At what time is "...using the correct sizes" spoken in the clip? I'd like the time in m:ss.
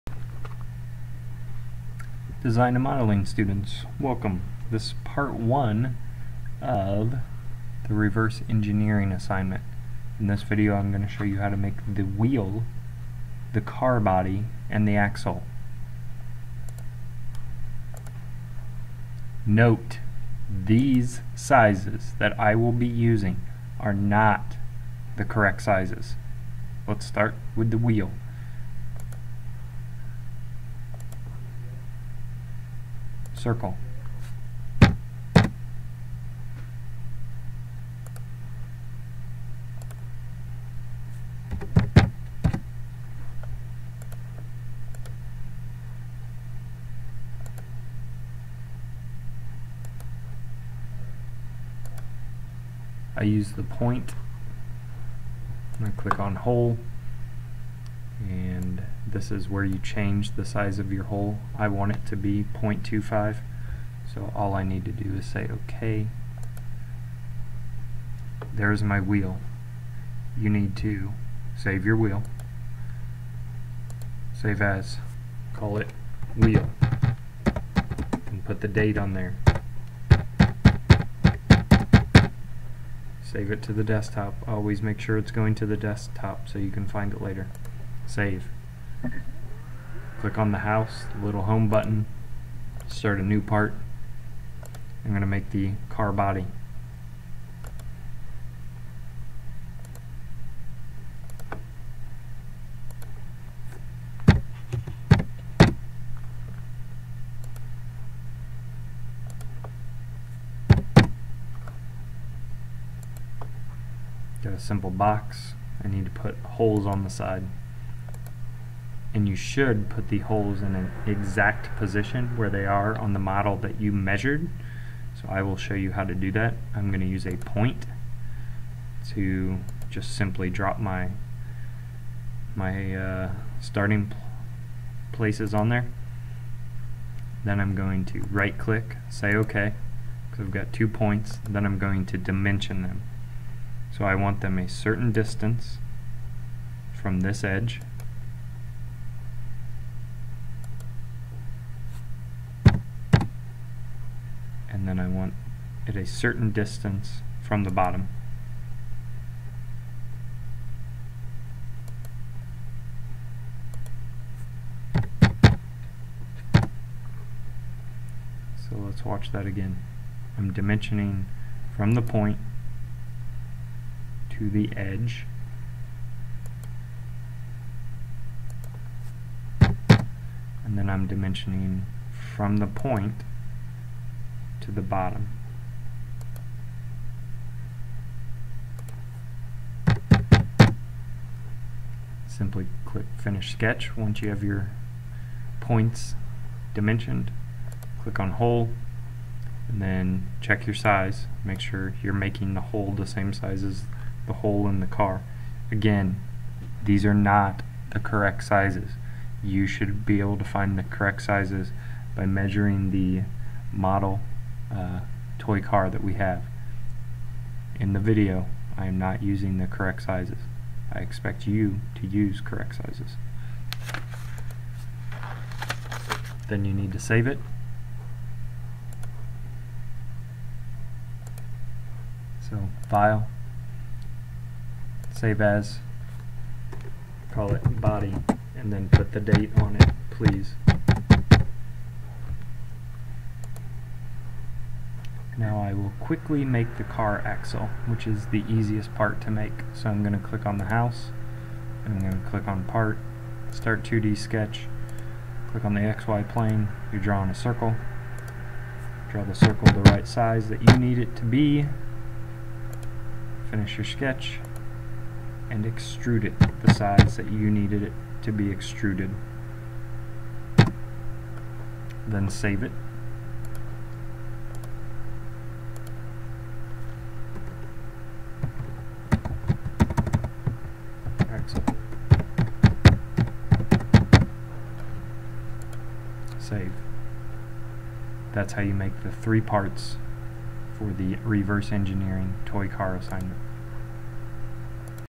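3:39.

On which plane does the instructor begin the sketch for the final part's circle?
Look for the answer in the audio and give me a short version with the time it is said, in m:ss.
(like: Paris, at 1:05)
XY plane, at 4:15.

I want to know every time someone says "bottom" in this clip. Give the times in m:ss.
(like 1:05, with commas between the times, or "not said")
2:37, 3:04.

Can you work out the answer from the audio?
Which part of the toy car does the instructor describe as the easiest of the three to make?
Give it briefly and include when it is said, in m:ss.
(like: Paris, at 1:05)
the car axle, at 4:06.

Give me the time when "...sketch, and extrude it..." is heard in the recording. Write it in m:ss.
4:23.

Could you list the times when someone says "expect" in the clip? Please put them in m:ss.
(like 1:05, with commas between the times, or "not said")
3:40.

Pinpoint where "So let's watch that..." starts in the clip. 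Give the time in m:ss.
2:48.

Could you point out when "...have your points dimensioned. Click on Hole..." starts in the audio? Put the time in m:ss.
3:14.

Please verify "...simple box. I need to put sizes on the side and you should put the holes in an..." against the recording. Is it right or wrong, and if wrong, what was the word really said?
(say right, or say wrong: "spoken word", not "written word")
wrong: "holes", not "sizes".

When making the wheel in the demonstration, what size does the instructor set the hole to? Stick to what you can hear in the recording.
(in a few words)
0.25.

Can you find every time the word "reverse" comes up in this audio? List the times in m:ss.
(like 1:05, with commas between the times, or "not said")
0:07, 4:51.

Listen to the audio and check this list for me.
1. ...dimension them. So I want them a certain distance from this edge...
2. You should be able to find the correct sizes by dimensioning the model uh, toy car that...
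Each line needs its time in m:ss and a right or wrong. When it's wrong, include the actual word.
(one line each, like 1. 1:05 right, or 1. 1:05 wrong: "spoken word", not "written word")
1. 2:22 right
2. 3:29 wrong: "measuring", not "dimensioning".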